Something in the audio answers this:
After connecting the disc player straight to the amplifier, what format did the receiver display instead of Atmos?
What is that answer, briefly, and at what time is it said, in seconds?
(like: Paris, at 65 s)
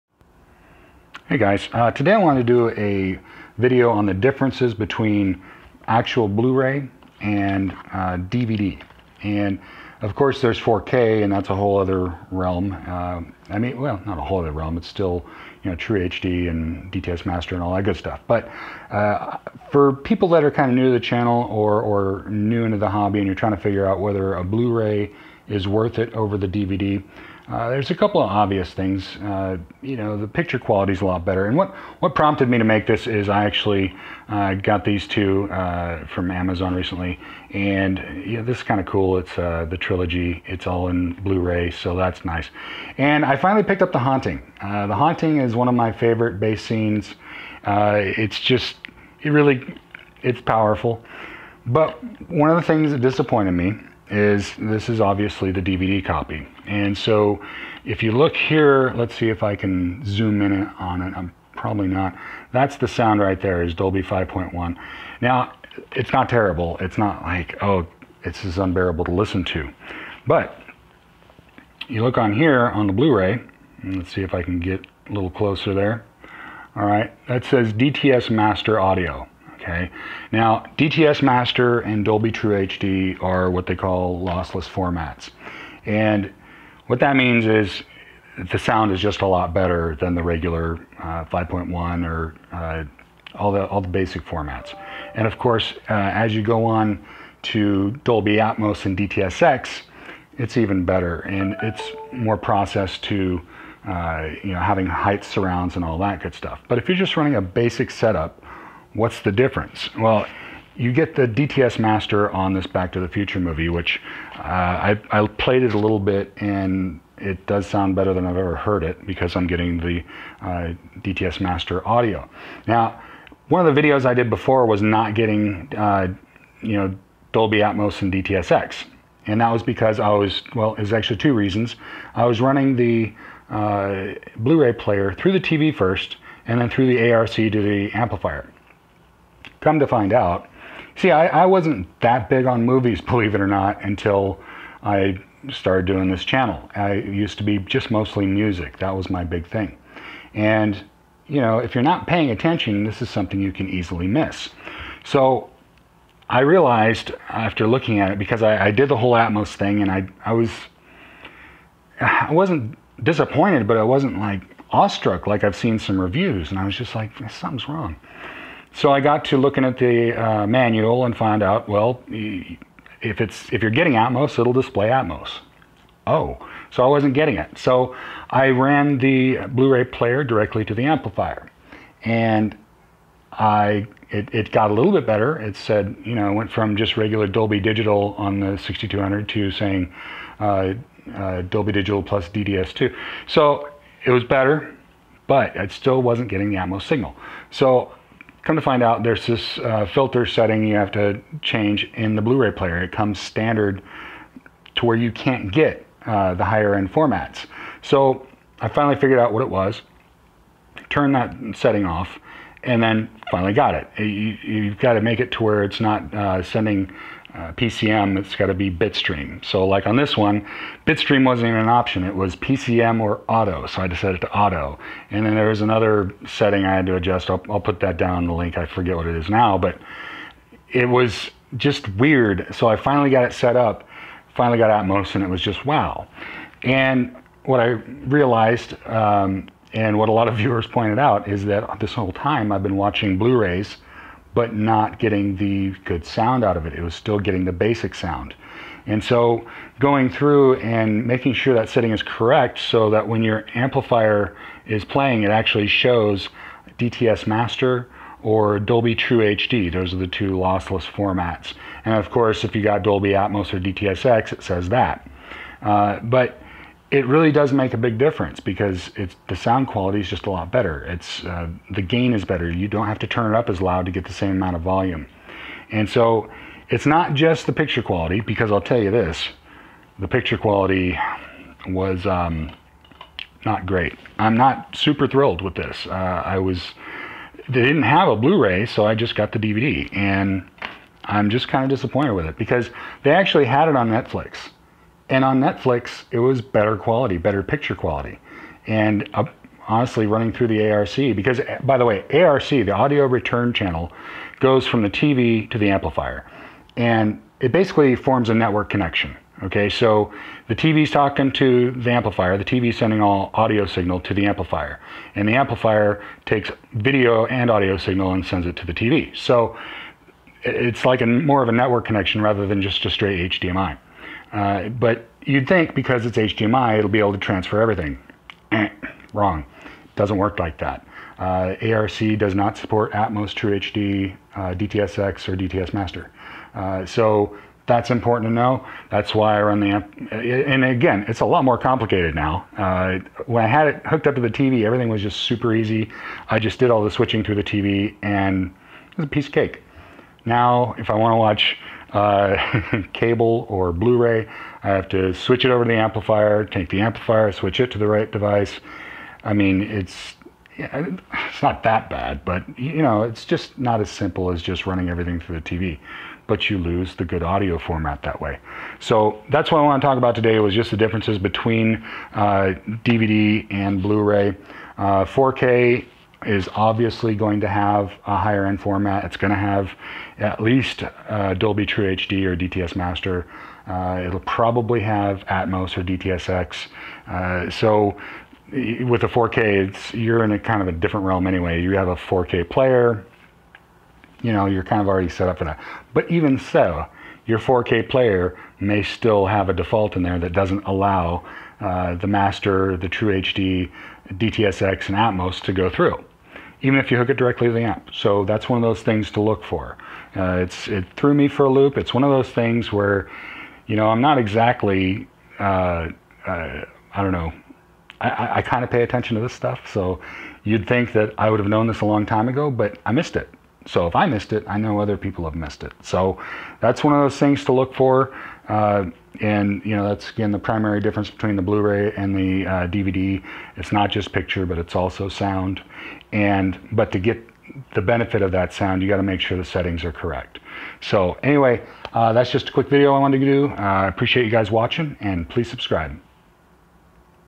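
Dolby Digital plus DDS2, at 191 s.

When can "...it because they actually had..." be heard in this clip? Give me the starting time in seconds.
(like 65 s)
292 s.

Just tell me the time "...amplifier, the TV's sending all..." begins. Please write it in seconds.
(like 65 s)
311 s.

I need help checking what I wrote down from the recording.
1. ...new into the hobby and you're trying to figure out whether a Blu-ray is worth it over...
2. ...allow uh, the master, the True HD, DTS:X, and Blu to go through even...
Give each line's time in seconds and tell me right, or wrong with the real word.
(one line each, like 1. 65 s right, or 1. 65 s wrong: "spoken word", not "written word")
1. 22 s right
2. 400 s wrong: "Atmos", not "Blu".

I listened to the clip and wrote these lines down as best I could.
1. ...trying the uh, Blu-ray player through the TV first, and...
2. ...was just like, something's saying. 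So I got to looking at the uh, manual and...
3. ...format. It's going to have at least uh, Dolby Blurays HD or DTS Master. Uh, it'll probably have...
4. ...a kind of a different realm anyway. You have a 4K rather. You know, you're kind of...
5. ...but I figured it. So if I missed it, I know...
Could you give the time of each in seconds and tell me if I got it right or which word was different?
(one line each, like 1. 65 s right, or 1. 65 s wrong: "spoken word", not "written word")
1. 132 s wrong: "running", not "trying"
2. 166 s wrong: "wrong", not "saying"
3. 378 s wrong: "True", not "Blurays"
4. 390 s wrong: "player", not "rather"
5. 422 s wrong: "missed", not "figured".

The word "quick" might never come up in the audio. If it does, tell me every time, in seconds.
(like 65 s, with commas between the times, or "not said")
442 s.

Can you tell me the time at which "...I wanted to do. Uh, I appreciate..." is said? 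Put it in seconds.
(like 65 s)
442 s.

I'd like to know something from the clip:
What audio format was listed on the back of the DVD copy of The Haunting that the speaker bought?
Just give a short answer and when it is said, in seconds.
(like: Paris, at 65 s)
Dolby 5.1, at 63 s.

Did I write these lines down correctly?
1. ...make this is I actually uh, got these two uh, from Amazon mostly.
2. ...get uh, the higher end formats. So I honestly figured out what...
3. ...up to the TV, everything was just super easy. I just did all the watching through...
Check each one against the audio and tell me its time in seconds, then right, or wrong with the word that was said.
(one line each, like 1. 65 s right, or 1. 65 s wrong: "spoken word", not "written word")
1. 32 s wrong: "recently", not "mostly"
2. 205 s wrong: "finally", not "honestly"
3. 344 s wrong: "switching", not "watching".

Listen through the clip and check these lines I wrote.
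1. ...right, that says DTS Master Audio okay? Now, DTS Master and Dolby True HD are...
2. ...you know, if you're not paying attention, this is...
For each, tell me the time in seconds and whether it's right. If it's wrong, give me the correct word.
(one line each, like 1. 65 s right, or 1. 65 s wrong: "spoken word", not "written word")
1. 76 s right
2. 151 s right.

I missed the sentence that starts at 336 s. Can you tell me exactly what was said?
Uh, so that's important to know.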